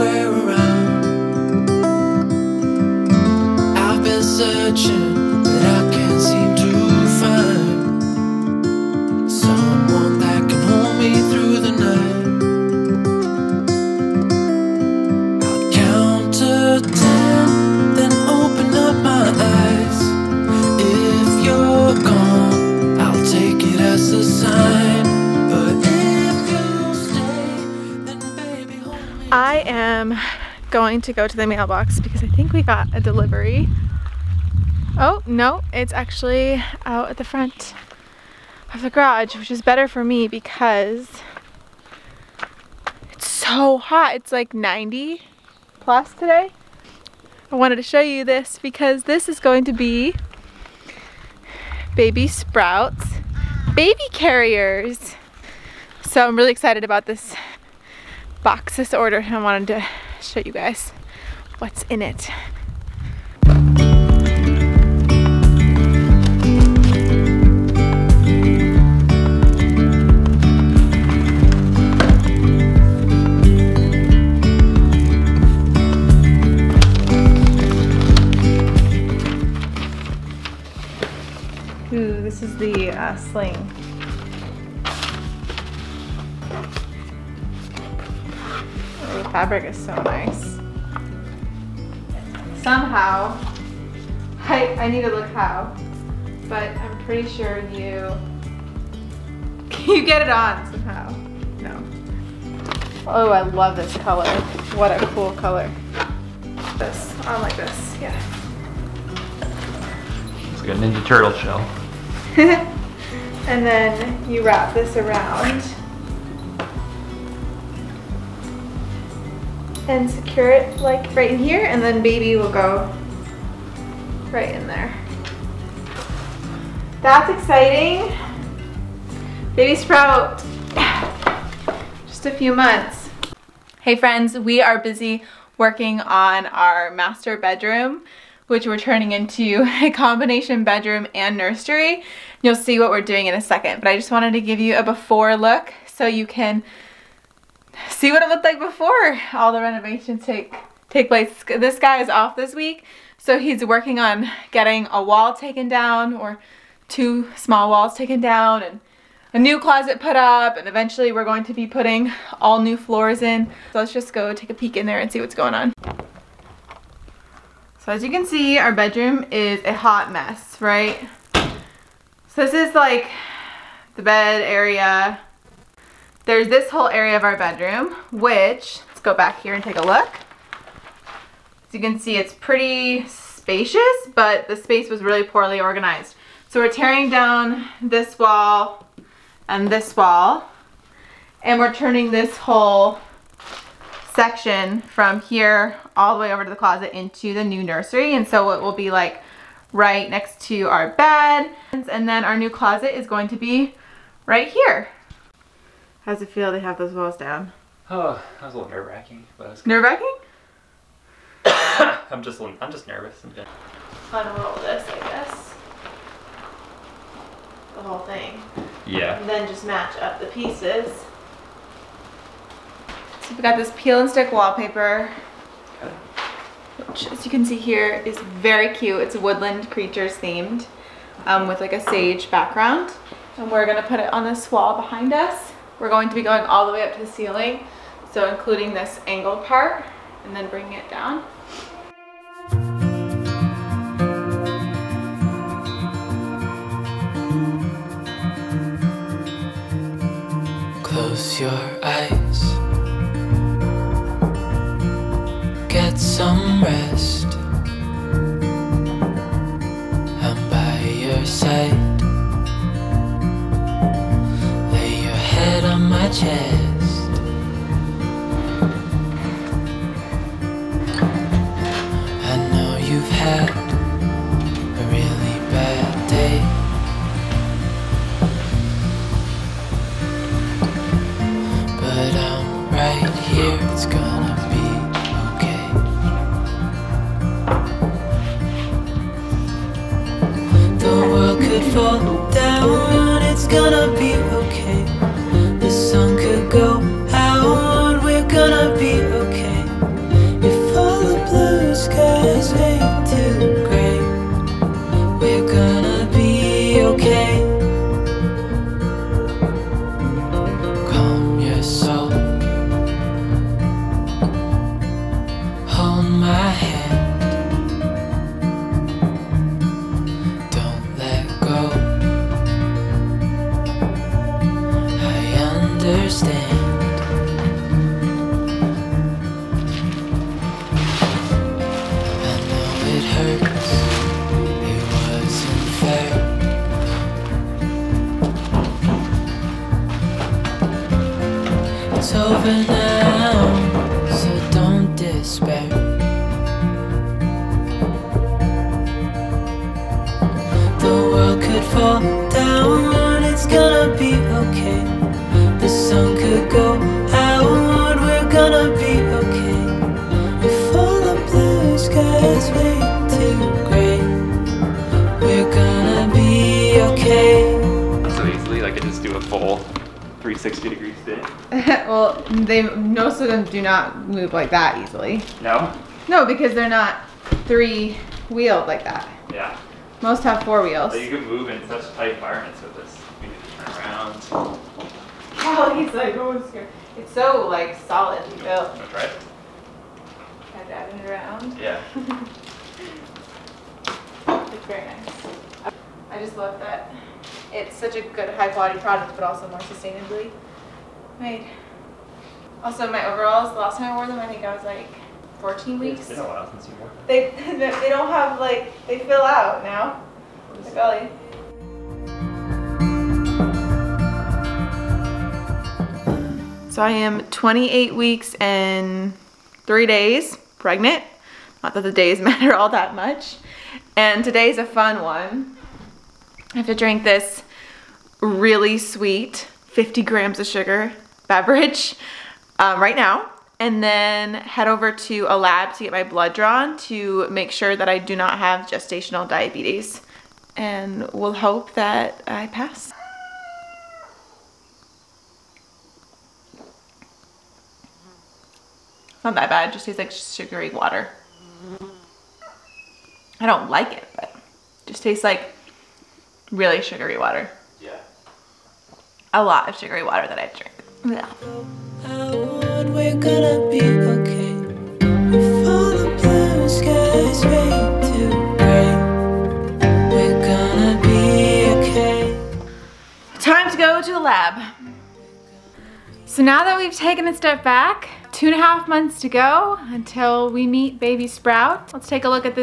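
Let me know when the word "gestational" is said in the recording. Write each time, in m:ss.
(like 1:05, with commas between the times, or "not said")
7:18.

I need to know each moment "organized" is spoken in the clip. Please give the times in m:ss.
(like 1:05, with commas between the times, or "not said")
3:05.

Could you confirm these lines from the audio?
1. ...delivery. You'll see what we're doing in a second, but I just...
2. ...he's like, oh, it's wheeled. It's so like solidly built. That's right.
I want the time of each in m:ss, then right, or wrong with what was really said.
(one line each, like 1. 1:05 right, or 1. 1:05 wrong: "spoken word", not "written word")
1. 2:21 wrong: "nursery", not "delivery"
2. 6:25 wrong: "scared", not "wheeled".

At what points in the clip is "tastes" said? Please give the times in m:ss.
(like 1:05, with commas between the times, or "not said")
7:29, 7:35.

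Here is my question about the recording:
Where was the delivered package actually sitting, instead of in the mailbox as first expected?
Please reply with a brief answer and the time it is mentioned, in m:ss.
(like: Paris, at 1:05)
Front of the garage, at 0:37.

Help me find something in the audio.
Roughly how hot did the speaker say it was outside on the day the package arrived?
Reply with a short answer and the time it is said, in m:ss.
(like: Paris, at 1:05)
90 plus, at 0:44.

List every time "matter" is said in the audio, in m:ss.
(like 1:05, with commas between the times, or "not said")
7:02.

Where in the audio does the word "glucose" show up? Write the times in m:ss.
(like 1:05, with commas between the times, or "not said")
not said.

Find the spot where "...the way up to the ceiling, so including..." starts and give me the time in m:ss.
3:56.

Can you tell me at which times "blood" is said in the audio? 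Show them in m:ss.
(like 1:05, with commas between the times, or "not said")
7:16.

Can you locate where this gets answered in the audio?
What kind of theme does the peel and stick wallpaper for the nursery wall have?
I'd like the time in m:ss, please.
3:49.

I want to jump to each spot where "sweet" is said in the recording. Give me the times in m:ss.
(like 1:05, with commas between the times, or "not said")
7:08.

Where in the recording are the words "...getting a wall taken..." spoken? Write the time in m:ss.
2:34.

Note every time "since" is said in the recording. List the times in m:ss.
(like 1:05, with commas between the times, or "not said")
6:46.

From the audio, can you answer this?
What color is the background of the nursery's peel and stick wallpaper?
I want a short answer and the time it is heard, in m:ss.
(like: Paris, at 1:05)
Sage, at 3:51.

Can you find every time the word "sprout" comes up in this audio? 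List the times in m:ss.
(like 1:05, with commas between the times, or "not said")
0:52, 2:09, 8:01.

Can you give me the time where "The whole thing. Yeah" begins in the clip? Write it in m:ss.
3:37.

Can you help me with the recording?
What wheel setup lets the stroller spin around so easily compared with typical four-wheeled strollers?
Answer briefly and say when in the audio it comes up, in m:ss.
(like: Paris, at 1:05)
Three wheeled, at 6:17.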